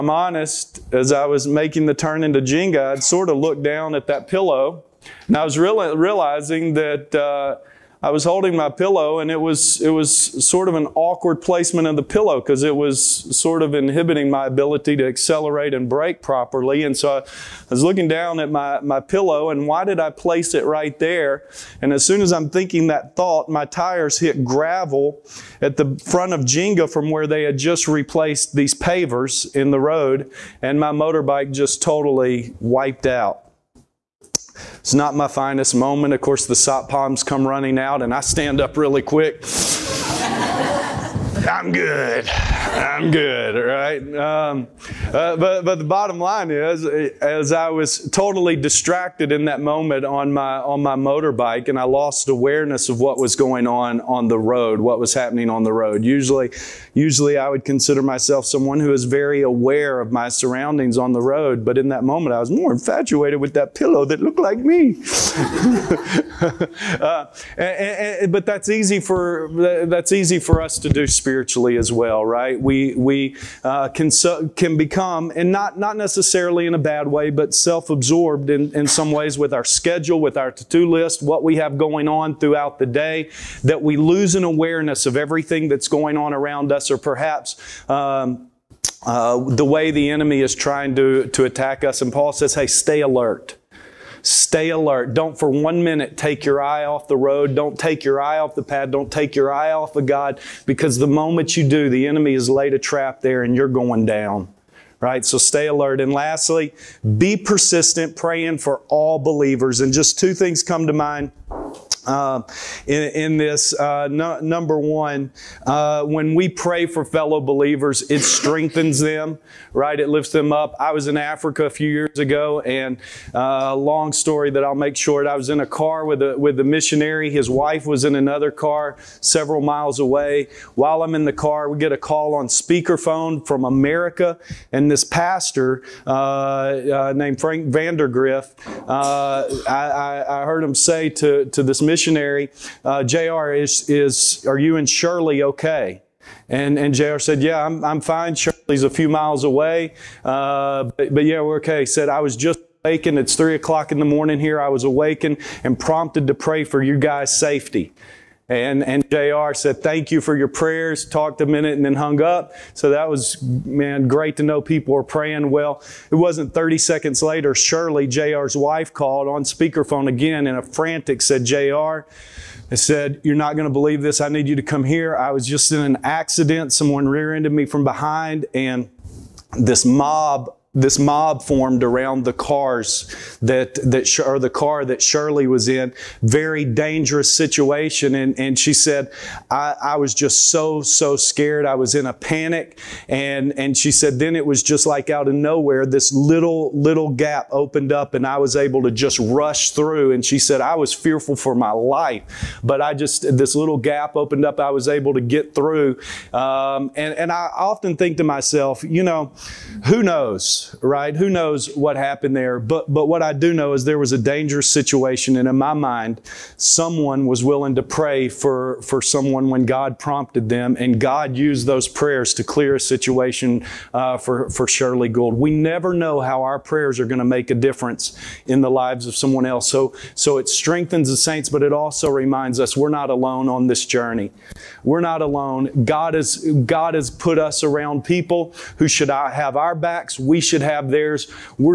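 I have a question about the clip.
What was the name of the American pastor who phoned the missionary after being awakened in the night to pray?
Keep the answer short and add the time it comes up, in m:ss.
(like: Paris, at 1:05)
Frank Vandergriff, at 2:17.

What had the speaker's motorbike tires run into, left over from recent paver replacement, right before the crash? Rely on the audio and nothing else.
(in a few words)
Gravel.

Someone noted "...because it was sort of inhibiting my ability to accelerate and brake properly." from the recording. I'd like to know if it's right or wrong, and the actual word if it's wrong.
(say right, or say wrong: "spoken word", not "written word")
right.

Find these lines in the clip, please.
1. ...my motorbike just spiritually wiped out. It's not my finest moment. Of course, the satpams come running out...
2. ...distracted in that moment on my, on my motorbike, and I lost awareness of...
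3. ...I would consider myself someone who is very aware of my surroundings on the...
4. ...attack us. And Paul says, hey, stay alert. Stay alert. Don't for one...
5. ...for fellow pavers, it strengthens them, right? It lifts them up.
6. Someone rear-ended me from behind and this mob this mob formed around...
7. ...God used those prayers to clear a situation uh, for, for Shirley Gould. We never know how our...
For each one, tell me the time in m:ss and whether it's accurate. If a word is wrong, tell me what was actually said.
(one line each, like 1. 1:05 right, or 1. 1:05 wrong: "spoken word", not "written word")
1. 0:30 wrong: "totally", not "spiritually"
2. 0:48 right
3. 0:57 right
4. 1:31 right
5. 1:56 wrong: "believers", not "pavers"
6. 2:56 right
7. 3:40 right.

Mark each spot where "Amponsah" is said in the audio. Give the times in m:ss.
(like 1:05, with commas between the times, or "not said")
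not said.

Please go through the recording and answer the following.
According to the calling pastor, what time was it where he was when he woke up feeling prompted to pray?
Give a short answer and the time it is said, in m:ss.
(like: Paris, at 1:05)
3 a.m., at 2:33.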